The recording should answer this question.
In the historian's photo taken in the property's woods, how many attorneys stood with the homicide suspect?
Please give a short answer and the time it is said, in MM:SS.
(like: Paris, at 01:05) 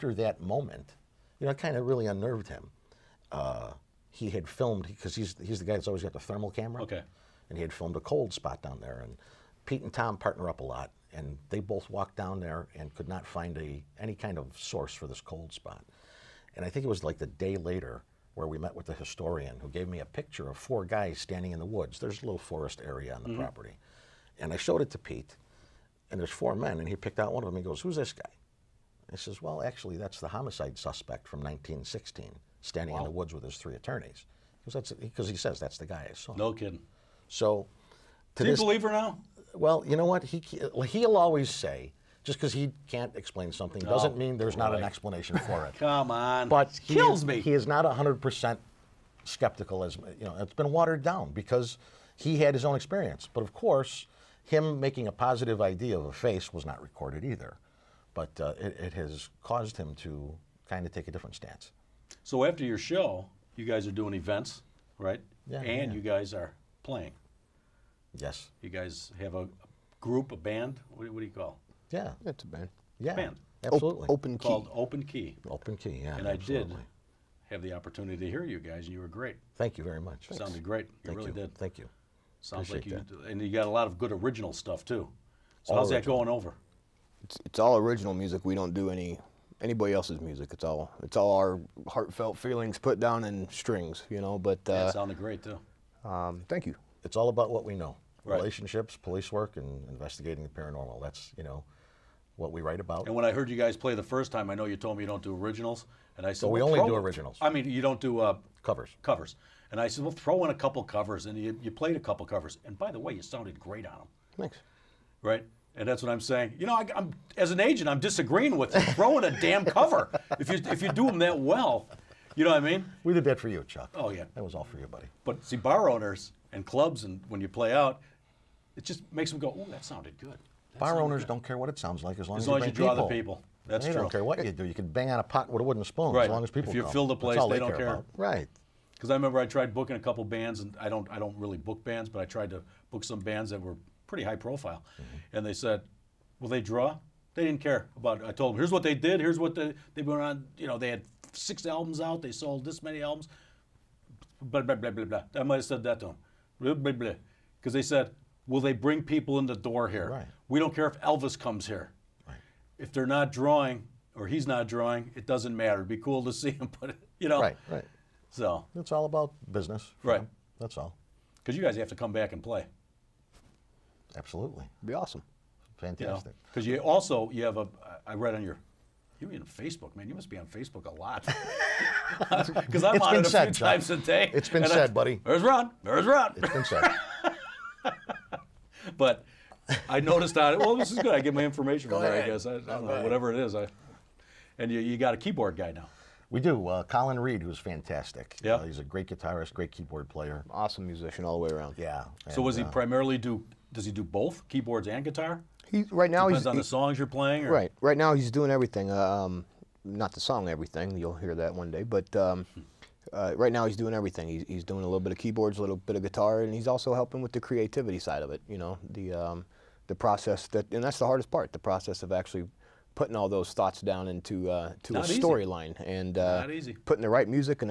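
3, at 00:33.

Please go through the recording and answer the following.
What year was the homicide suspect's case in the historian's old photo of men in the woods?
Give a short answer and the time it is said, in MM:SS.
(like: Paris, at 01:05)
1916, at 00:31.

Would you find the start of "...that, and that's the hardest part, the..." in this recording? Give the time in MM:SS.
03:40.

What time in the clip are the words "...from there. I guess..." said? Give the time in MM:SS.
03:11.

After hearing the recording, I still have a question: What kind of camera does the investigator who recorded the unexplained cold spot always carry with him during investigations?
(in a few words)
thermal camera.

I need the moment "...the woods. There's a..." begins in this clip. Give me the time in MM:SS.
00:21.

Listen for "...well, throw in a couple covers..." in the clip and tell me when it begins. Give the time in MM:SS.
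01:50.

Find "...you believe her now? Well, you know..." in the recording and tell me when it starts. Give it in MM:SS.
00:38.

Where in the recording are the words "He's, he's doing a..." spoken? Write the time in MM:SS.
03:34.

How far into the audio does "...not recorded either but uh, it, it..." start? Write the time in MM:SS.
00:56.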